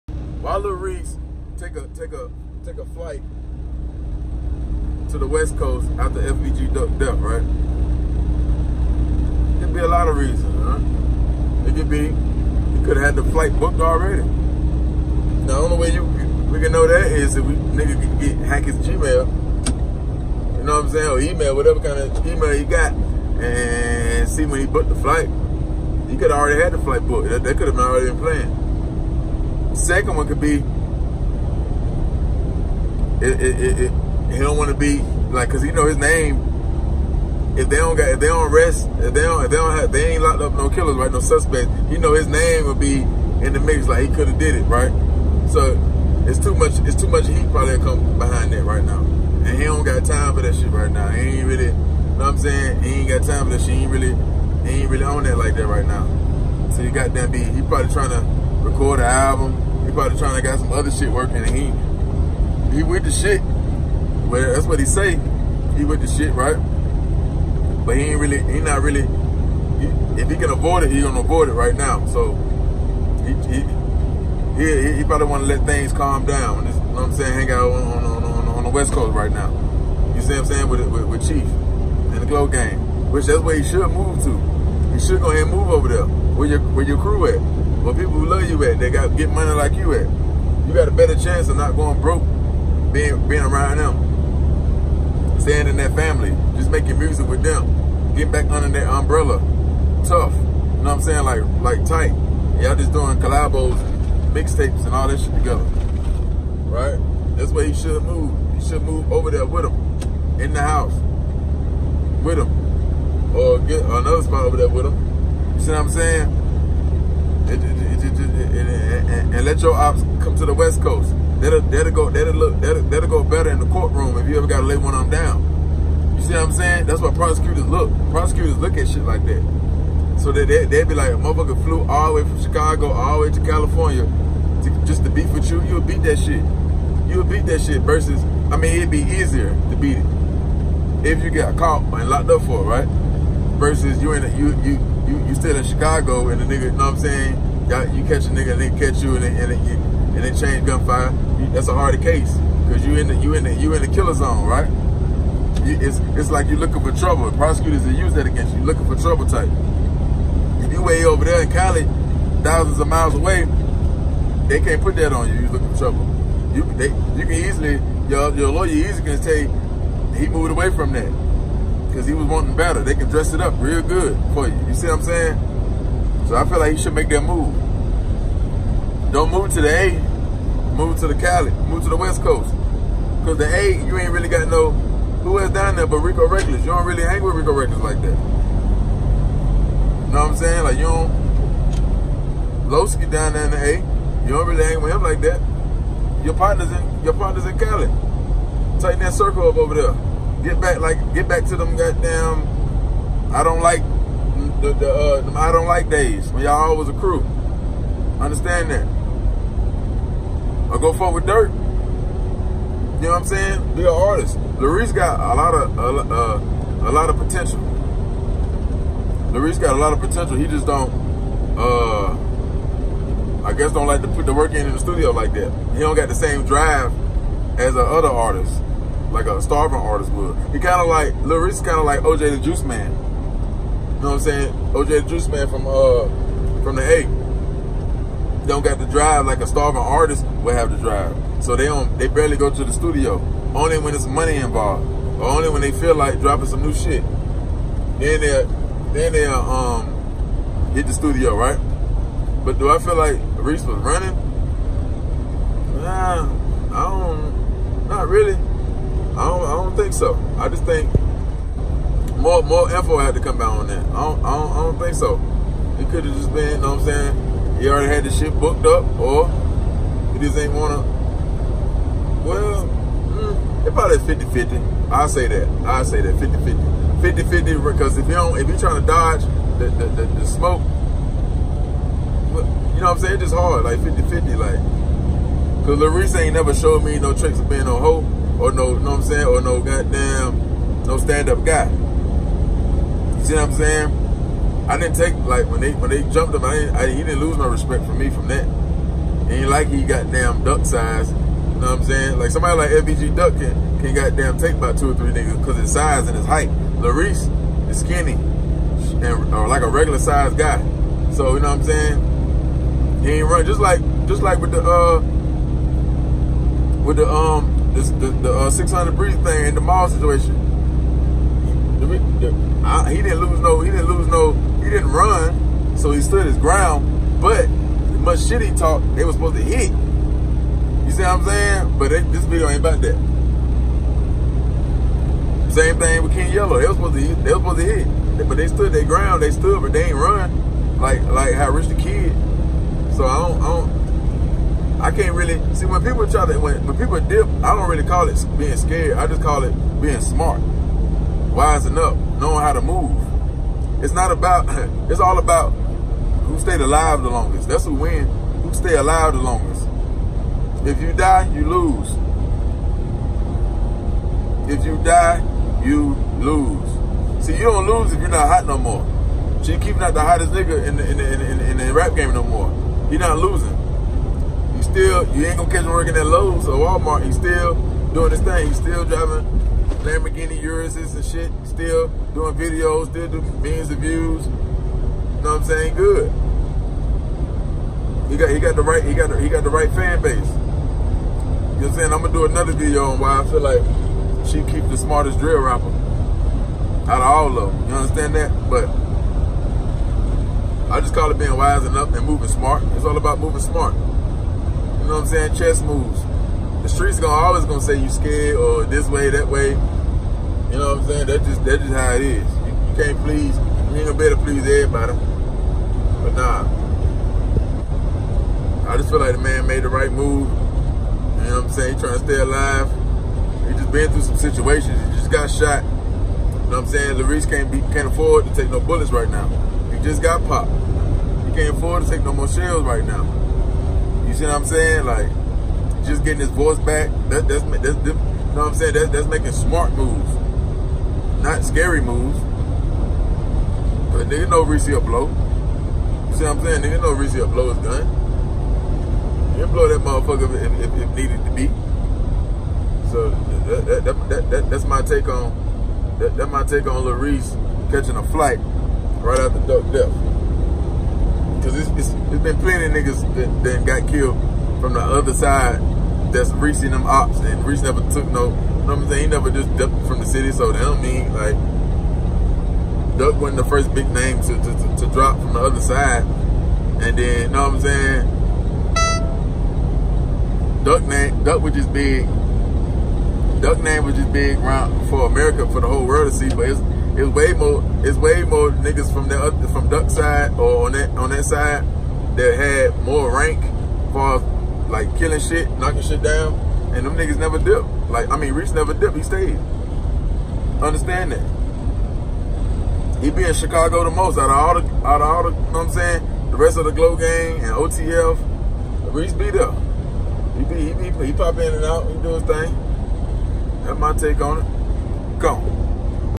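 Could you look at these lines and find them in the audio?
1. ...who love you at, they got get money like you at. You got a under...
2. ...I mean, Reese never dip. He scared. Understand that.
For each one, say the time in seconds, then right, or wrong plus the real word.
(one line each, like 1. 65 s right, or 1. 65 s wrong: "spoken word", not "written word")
1. 88 s wrong: "better", not "under"
2. 498 s wrong: "stayed", not "scared".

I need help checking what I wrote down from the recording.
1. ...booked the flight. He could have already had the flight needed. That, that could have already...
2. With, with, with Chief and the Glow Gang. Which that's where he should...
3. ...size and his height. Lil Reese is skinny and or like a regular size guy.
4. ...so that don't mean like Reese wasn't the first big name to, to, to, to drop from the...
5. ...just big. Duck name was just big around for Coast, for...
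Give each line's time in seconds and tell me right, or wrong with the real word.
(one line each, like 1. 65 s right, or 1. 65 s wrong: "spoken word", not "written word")
1. 24 s wrong: "booked", not "needed"
2. 80 s right
3. 305 s right
4. 470 s wrong: "Duck", not "Reese"
5. 481 s wrong: "America", not "Coast".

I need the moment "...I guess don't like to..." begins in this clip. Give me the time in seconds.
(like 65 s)
223 s.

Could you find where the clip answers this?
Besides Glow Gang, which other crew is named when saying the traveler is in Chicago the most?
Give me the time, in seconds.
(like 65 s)
507 s.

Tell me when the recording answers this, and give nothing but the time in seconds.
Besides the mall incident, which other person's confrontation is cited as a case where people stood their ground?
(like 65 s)
336 s.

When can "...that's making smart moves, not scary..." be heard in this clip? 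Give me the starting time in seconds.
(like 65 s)
438 s.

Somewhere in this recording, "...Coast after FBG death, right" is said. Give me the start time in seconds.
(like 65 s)
5 s.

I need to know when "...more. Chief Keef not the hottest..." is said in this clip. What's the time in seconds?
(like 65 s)
368 s.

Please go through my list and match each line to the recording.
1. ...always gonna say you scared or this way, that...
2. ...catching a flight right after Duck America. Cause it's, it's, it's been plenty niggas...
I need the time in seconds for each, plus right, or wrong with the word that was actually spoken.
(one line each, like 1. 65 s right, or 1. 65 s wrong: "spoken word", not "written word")
1. 407 s right
2. 457 s wrong: "Death", not "America".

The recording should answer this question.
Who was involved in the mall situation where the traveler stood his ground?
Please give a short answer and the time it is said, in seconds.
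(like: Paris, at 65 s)
600 Breezy, at 318 s.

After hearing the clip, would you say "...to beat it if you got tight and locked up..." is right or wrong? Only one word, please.
wrong.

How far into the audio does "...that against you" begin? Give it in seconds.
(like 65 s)
158 s.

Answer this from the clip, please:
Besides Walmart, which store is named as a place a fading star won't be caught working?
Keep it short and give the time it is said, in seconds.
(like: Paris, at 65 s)
Lowe's, at 376 s.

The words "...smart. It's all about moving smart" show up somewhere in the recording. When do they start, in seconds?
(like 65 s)
402 s.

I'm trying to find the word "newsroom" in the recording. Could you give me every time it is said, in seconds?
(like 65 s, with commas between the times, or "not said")
not said.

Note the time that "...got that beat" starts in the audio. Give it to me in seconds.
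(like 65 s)
56 s.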